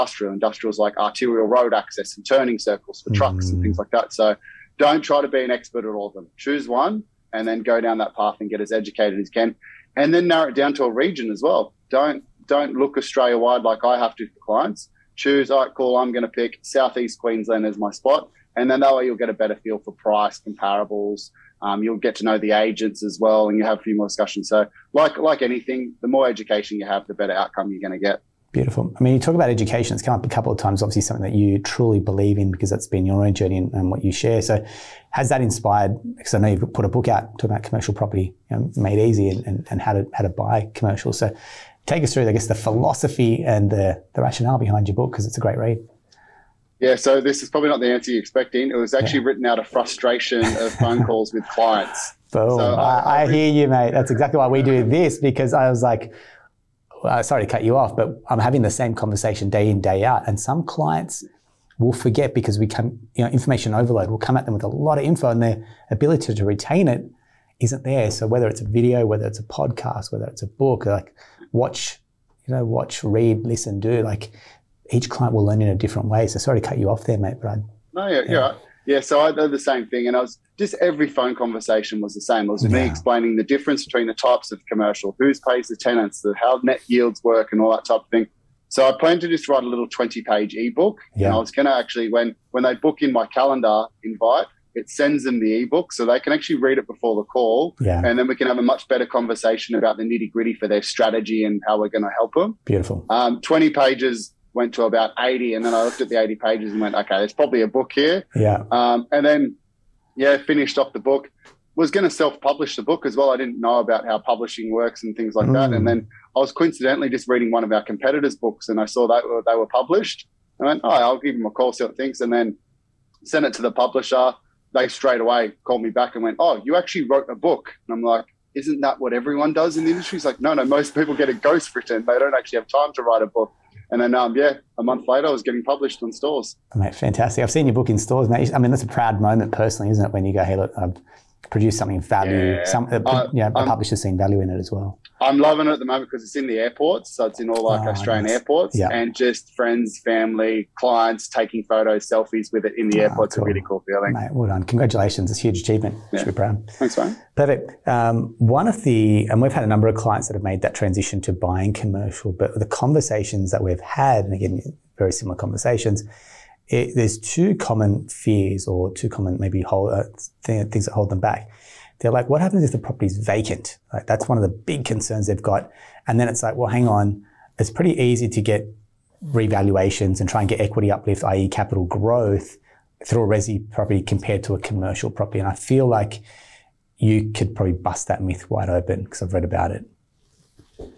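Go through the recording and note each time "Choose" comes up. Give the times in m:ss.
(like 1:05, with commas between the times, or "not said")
0:06, 0:15.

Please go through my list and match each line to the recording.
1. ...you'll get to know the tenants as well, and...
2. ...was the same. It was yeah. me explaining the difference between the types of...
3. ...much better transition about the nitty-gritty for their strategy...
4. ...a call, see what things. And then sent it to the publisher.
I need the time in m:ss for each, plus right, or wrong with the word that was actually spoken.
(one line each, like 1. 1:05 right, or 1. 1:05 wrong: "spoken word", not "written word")
1. 0:21 wrong: "agents", not "tenants"
2. 1:22 right
3. 1:38 wrong: "conversation", not "transition"
4. 2:01 right.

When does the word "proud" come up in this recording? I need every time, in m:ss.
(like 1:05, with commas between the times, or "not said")
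2:18, 2:36.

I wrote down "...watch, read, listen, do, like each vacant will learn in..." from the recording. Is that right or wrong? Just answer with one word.
wrong.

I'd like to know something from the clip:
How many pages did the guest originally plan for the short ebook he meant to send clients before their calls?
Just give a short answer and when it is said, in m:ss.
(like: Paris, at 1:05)
20, at 1:29.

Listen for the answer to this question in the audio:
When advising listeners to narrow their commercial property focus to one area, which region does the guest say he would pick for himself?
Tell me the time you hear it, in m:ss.
0:16.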